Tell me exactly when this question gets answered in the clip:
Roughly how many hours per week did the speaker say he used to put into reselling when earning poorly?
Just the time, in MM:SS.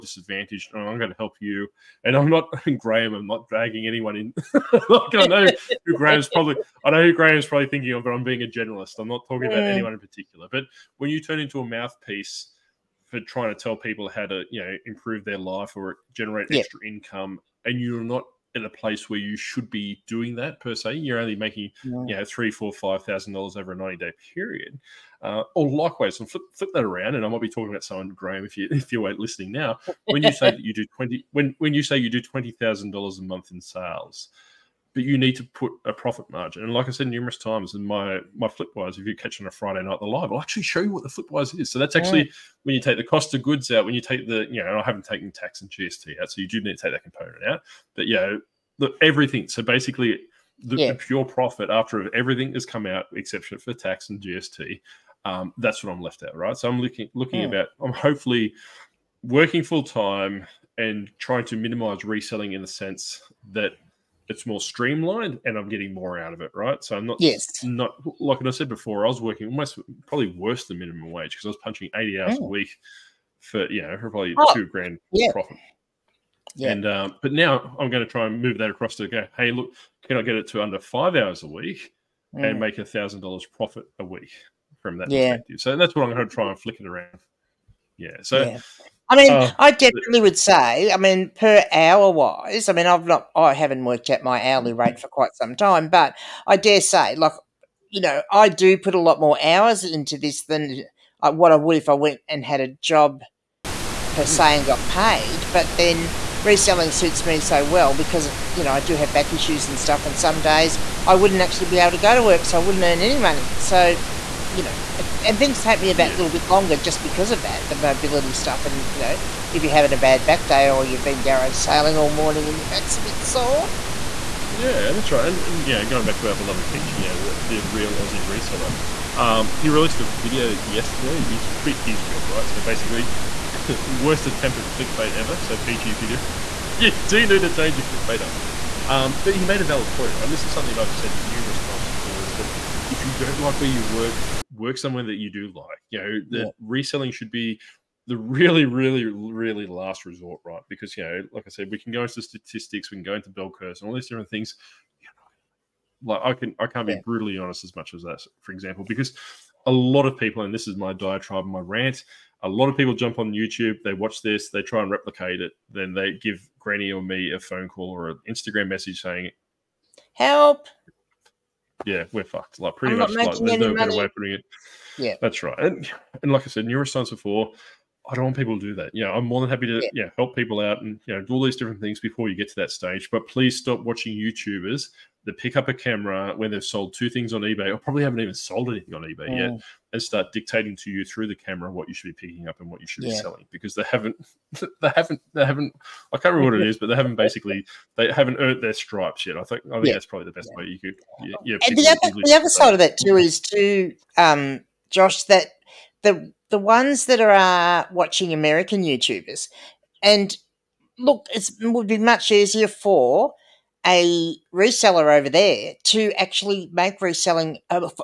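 01:11.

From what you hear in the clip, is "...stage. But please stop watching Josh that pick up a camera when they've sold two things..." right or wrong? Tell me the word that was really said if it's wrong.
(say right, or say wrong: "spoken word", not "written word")
wrong: "YouTubers", not "Josh".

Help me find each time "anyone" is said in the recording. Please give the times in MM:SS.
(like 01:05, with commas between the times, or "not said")
00:03, 00:09.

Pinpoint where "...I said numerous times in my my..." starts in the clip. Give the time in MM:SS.
00:36.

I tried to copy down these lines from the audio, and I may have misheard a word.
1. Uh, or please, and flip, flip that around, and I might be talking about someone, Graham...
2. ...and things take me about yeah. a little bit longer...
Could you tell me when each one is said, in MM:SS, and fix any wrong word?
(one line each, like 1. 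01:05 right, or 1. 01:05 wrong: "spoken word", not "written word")
1. 00:25 wrong: "likewise", not "please"
2. 01:55 right.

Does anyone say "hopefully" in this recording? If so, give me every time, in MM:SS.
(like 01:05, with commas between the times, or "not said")
00:57.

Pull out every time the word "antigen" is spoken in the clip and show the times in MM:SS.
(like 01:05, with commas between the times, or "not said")
not said.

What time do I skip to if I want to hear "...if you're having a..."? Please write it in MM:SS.
01:59.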